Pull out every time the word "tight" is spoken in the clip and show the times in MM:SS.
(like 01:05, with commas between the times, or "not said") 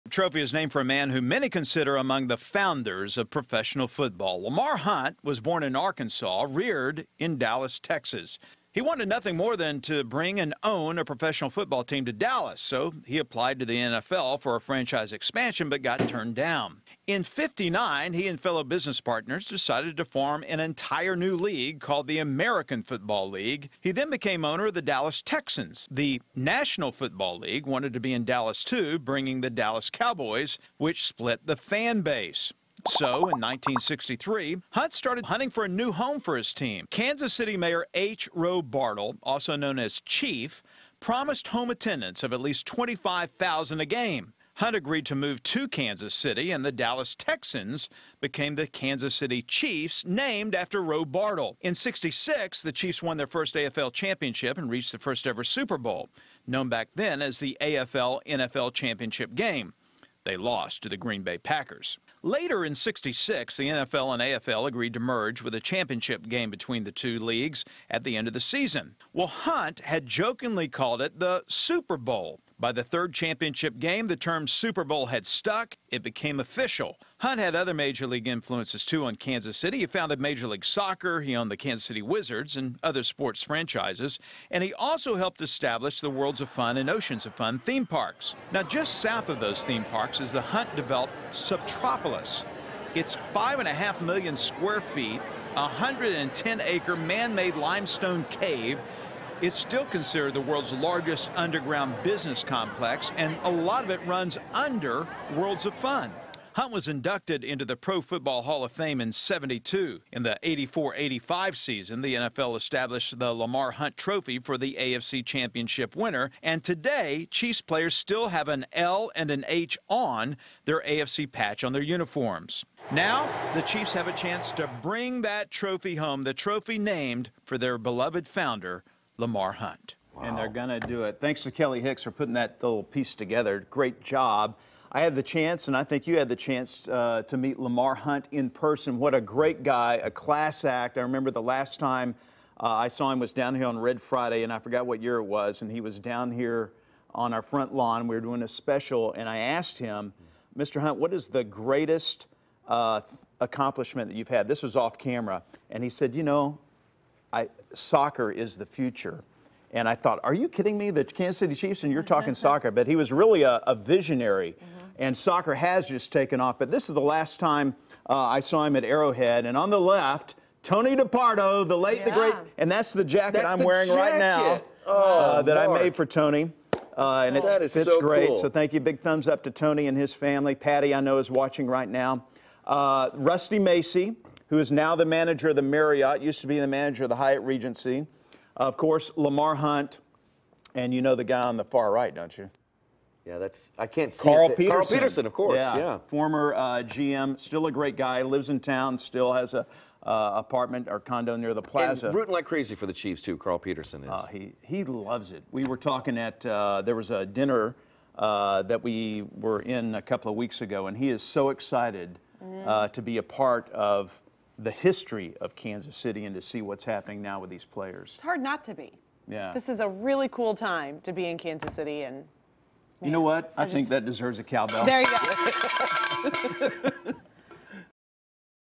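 not said.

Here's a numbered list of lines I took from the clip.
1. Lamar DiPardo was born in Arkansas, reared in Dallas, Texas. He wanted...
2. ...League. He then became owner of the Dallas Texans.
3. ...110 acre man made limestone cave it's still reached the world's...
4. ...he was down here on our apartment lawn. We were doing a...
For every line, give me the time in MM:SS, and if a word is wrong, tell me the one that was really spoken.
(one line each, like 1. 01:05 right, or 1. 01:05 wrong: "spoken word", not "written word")
1. 00:04 wrong: "Hunt", not "DiPardo"
2. 00:23 right
3. 01:35 wrong: "considered", not "reached"
4. 02:25 wrong: "front", not "apartment".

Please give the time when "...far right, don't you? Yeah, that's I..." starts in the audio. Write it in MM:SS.
03:11.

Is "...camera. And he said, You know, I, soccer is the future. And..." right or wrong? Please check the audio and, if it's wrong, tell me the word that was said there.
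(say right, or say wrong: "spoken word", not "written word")
right.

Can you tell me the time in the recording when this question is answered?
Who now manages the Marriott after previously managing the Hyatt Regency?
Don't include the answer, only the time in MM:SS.
03:03.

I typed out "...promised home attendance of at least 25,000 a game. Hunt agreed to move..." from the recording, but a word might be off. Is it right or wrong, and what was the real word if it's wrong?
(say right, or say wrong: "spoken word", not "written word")
right.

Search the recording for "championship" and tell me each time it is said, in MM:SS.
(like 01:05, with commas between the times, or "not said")
00:53, 00:58, 01:05, 01:13, 01:55.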